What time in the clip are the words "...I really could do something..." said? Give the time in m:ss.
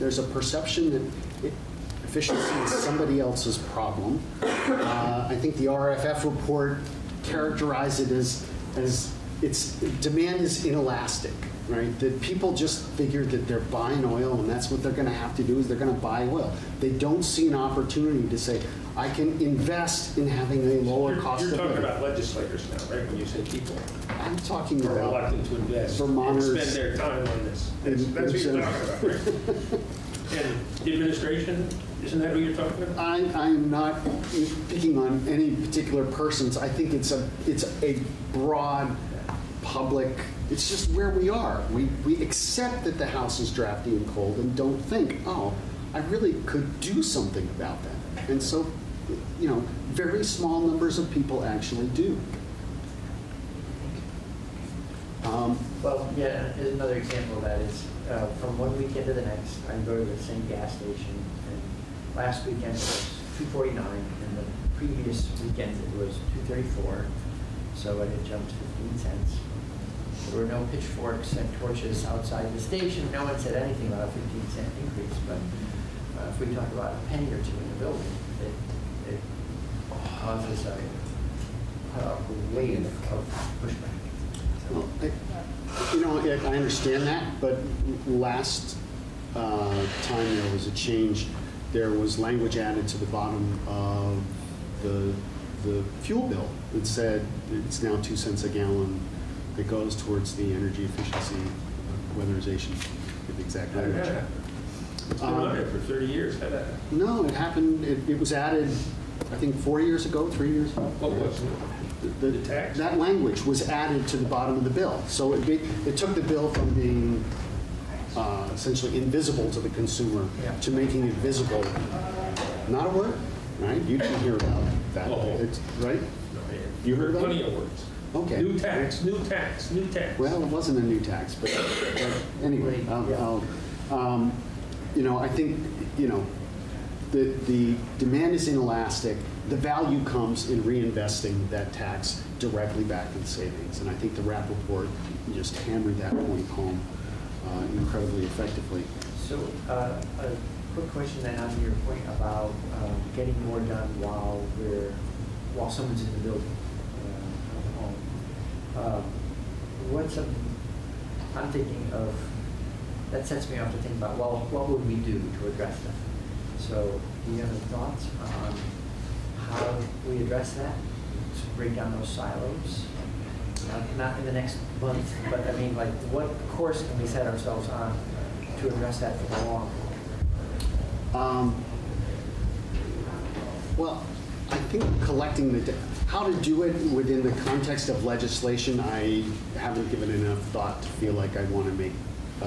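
0:45.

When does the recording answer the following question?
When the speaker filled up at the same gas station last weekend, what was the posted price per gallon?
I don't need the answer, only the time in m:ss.
1:03.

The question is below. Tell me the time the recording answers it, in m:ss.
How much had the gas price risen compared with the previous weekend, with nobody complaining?
1:08.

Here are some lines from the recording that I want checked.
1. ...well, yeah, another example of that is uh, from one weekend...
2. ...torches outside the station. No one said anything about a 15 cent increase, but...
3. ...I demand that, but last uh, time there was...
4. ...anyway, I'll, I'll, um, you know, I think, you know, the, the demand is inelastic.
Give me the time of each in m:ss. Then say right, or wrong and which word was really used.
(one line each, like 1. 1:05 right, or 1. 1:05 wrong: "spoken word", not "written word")
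1. 0:55 right
2. 1:11 right
3. 1:26 wrong: "understand", not "demand"
4. 2:12 right.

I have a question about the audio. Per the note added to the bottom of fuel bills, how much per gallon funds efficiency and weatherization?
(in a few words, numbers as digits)
2 cents.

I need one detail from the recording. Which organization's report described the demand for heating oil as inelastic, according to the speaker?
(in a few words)
RFF.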